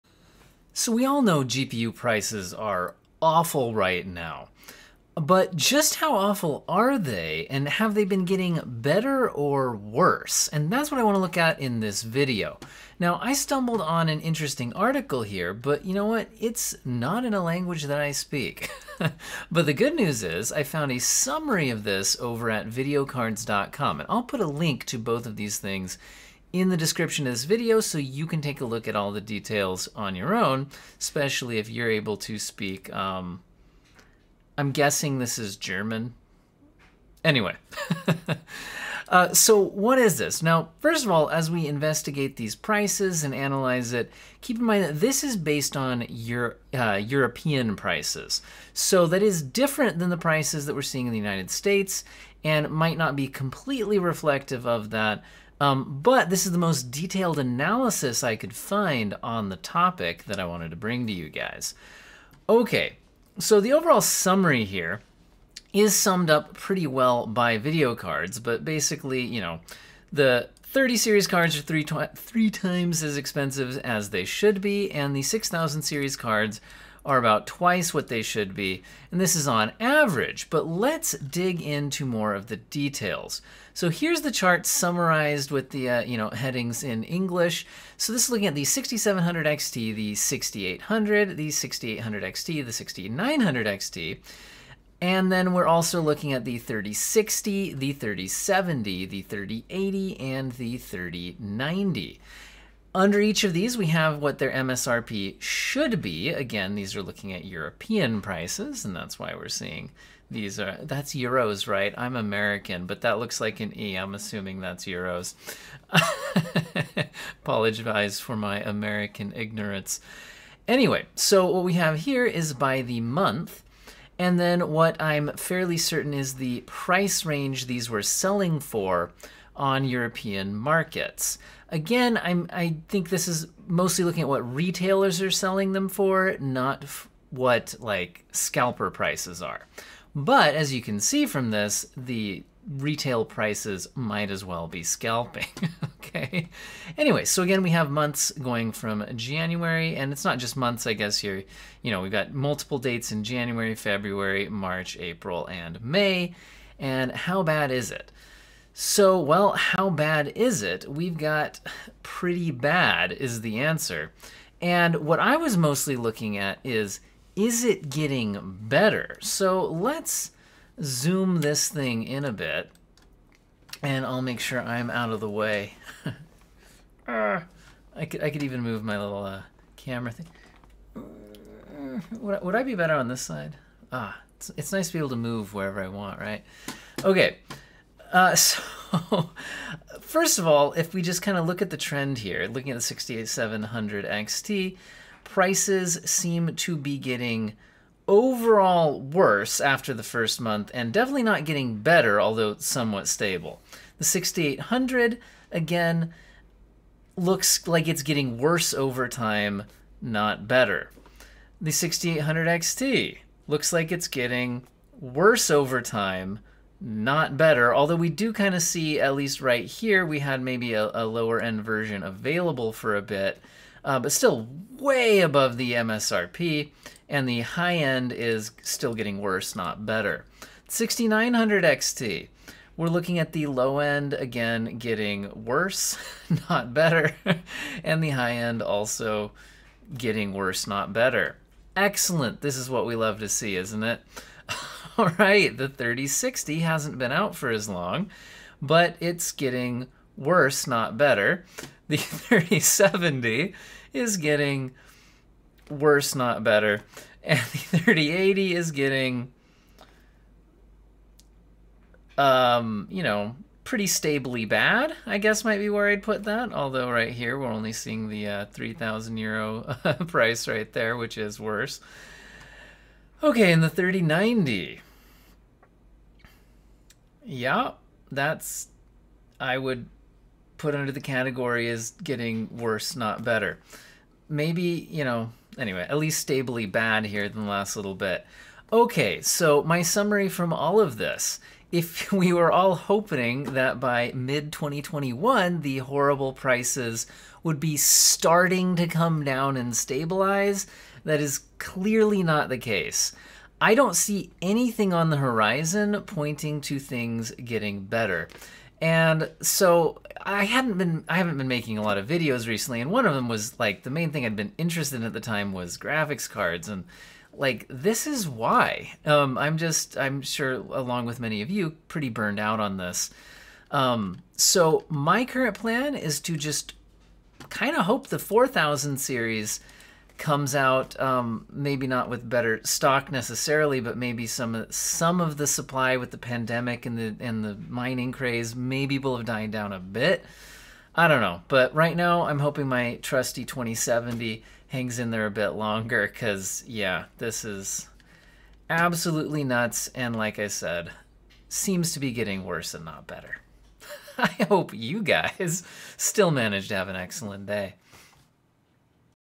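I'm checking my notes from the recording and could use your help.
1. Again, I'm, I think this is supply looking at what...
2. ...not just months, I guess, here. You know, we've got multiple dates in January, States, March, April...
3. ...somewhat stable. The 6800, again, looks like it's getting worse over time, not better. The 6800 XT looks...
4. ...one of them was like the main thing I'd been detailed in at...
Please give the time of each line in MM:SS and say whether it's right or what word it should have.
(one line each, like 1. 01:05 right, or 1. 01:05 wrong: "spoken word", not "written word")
1. 02:11 wrong: "mostly", not "supply"
2. 02:30 wrong: "February", not "States"
3. 03:22 right
4. 05:12 wrong: "interested", not "detailed".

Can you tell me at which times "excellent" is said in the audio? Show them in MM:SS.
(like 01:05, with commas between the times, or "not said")
04:01, 05:56.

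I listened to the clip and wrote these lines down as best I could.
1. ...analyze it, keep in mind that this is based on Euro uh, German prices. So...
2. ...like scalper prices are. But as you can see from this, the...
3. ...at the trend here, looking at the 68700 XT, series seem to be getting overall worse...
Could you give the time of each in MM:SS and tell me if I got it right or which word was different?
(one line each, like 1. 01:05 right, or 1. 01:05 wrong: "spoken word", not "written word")
1. 00:43 wrong: "European", not "German"
2. 02:17 right
3. 03:11 wrong: "prices", not "series".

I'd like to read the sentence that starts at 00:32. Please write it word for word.
Um, I'm guessing this is German.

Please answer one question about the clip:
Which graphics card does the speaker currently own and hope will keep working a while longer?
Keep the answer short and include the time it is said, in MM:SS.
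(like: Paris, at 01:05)
2070, at 05:43.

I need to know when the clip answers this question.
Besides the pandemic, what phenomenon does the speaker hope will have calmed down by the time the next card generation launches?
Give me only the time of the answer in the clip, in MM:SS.
05:37.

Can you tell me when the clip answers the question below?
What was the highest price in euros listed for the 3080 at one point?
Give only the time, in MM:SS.
04:28.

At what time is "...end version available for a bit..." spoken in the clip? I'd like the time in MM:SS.
03:41.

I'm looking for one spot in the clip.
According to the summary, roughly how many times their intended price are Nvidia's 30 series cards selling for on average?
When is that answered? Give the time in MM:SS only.
01:12.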